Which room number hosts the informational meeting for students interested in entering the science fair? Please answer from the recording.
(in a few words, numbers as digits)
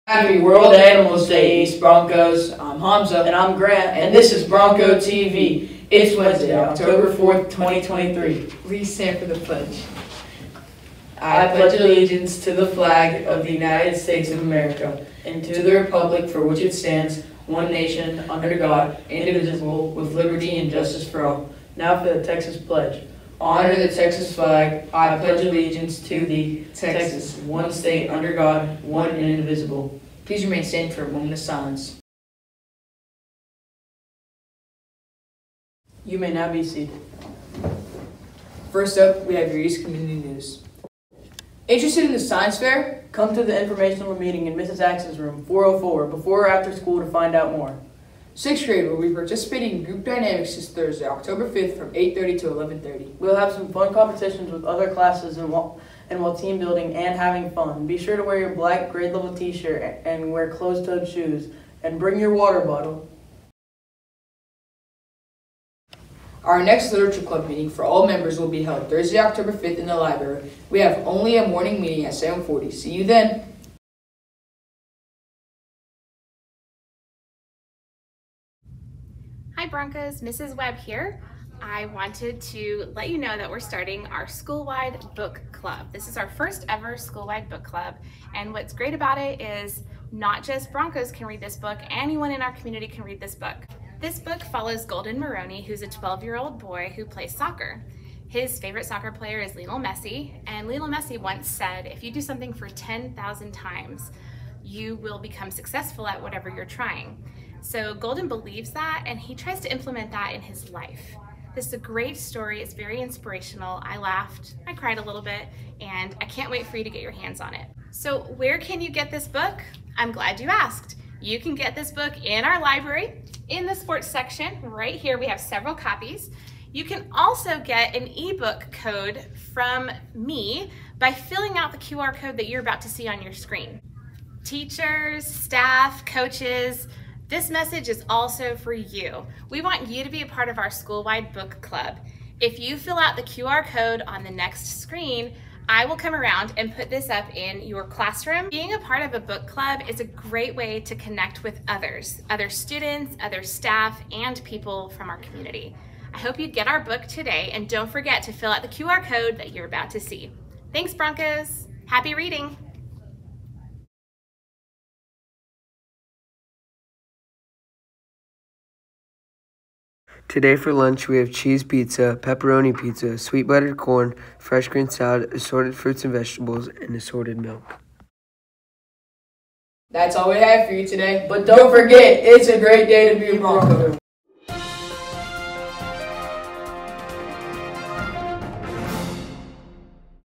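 404.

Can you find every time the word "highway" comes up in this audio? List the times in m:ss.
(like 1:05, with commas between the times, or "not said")
not said.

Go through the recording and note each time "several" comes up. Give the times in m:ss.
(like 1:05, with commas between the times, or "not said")
2:05.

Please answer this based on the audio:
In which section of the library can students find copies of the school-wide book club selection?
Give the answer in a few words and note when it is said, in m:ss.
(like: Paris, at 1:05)
Sports section, at 2:03.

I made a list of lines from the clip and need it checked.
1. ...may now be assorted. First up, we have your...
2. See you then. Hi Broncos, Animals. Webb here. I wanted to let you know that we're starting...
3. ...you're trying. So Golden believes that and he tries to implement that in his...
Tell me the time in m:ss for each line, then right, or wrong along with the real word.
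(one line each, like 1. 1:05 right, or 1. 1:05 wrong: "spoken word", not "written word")
1. 0:36 wrong: "seated", not "assorted"
2. 1:12 wrong: "Mrs", not "Animals"
3. 1:46 right.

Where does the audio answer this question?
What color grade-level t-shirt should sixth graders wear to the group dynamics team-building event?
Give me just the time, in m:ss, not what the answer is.
0:58.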